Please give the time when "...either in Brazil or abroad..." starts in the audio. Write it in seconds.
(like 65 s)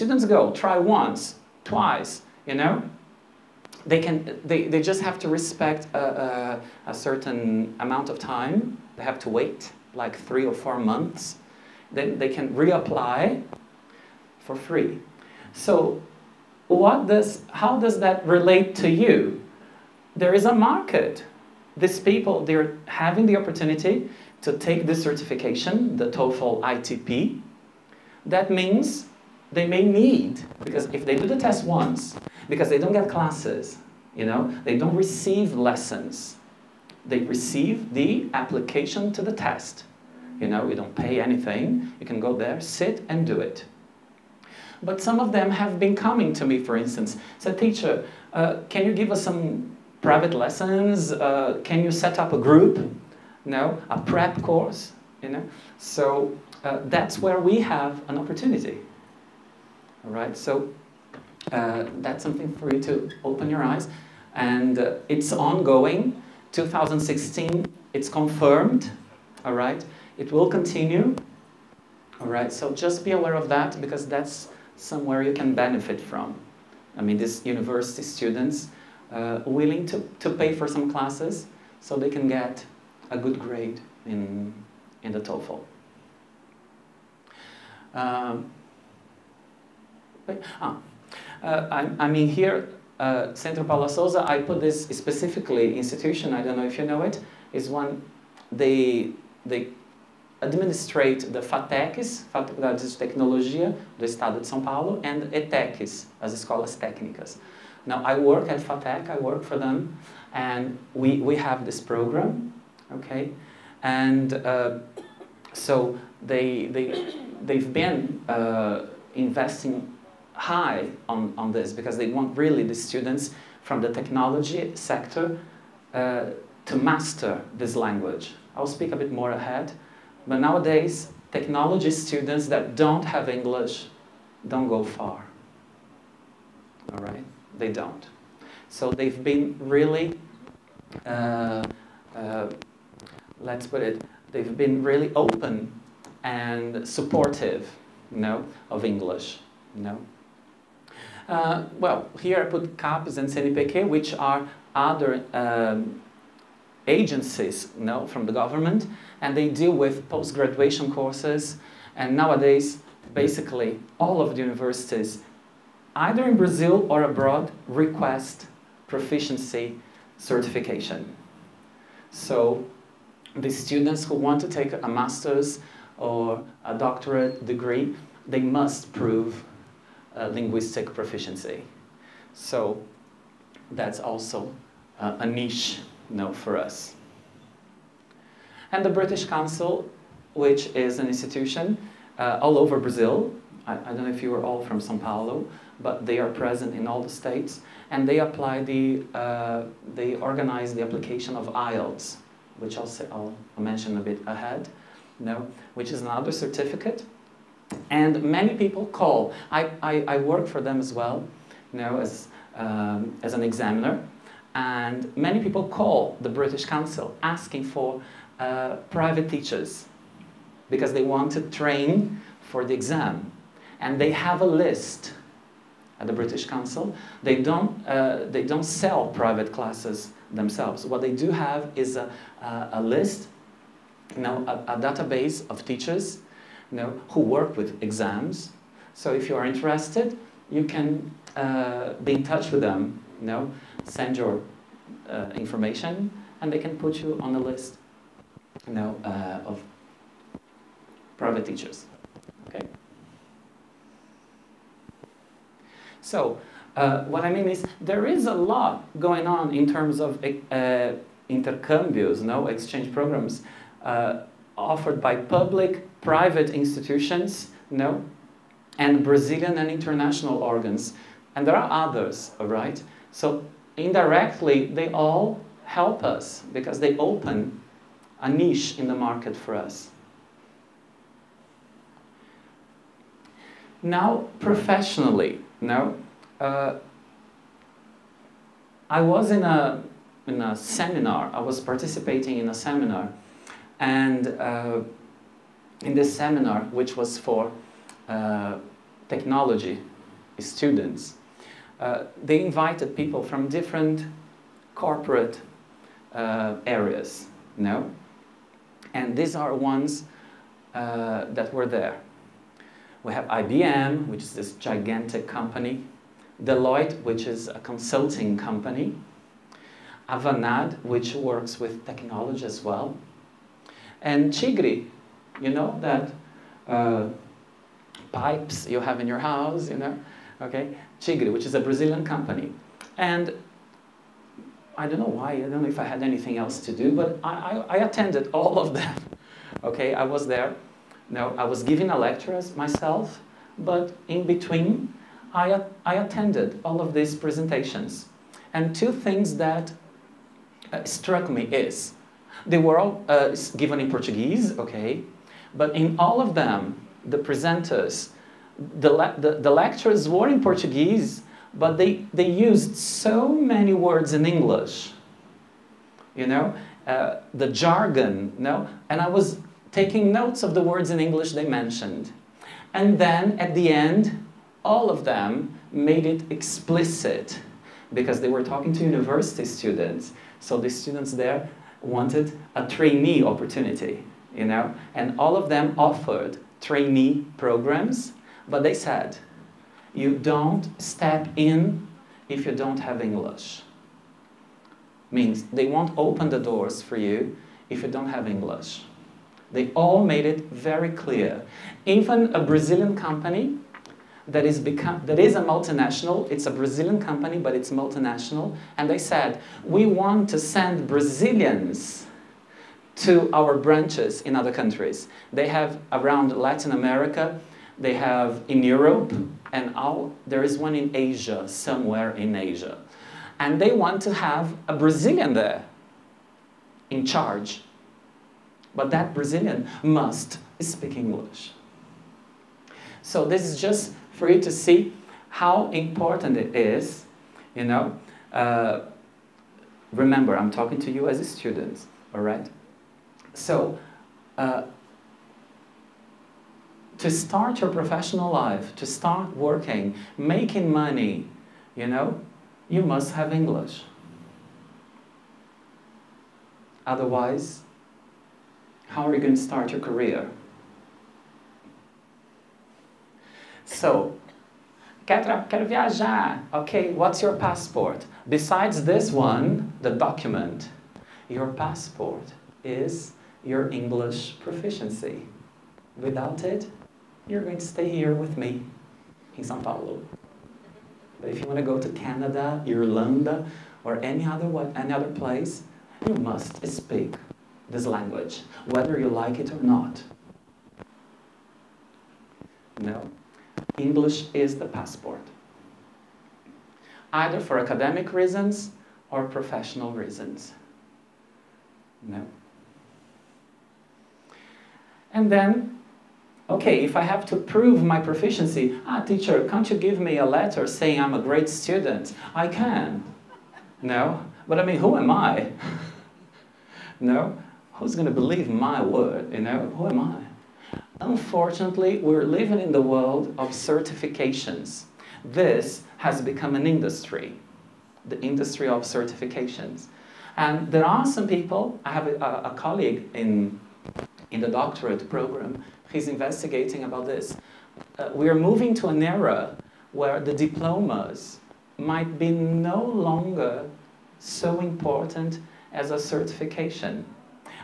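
165 s.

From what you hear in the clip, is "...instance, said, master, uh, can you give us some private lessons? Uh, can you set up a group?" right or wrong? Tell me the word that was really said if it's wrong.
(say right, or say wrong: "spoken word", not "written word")
wrong: "teacher", not "master".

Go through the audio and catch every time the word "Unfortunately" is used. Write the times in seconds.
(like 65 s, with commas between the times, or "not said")
521 s.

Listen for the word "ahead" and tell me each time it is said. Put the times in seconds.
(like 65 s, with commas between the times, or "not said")
129 s, 204 s.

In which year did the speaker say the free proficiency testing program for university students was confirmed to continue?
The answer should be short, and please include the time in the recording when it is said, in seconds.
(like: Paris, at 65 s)
2016, at 66 s.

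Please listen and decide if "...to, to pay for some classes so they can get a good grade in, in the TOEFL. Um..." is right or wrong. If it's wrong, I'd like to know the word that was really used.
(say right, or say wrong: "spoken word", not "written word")
right.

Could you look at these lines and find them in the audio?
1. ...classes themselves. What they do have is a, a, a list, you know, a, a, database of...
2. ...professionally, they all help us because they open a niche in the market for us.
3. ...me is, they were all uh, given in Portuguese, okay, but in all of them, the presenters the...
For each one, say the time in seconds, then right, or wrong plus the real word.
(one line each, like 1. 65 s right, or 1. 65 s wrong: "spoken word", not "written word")
1. 229 s right
2. 273 s wrong: "indirectly", not "professionally"
3. 351 s right.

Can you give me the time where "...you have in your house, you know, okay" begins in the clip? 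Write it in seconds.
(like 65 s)
328 s.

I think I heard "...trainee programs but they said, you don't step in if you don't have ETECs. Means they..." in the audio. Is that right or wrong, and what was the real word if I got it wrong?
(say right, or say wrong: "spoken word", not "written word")
wrong: "English", not "ETECs".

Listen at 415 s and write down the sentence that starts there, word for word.
They have around Latin America they have in Europe, and all, there is one in Asia, somewhere in Asia.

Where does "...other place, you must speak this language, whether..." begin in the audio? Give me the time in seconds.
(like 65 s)
484 s.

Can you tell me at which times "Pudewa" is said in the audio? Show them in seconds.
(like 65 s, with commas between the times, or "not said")
not said.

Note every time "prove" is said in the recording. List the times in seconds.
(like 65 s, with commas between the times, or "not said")
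178 s, 507 s.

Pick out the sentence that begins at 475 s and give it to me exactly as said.
Without it, you're going to stay here with me in Sao Paulo.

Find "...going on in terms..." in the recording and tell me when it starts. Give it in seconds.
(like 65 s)
258 s.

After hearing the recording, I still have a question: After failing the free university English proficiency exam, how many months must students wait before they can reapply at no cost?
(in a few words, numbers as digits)
3 or 4 months.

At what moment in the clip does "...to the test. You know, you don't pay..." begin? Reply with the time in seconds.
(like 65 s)
39 s.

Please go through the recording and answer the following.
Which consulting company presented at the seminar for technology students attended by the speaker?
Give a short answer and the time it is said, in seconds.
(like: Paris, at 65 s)
Deloitte, at 316 s.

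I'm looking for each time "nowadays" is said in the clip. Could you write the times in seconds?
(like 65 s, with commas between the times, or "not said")
130 s, 162 s.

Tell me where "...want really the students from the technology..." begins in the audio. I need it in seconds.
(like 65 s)
122 s.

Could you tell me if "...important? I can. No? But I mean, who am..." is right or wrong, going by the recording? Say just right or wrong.
wrong.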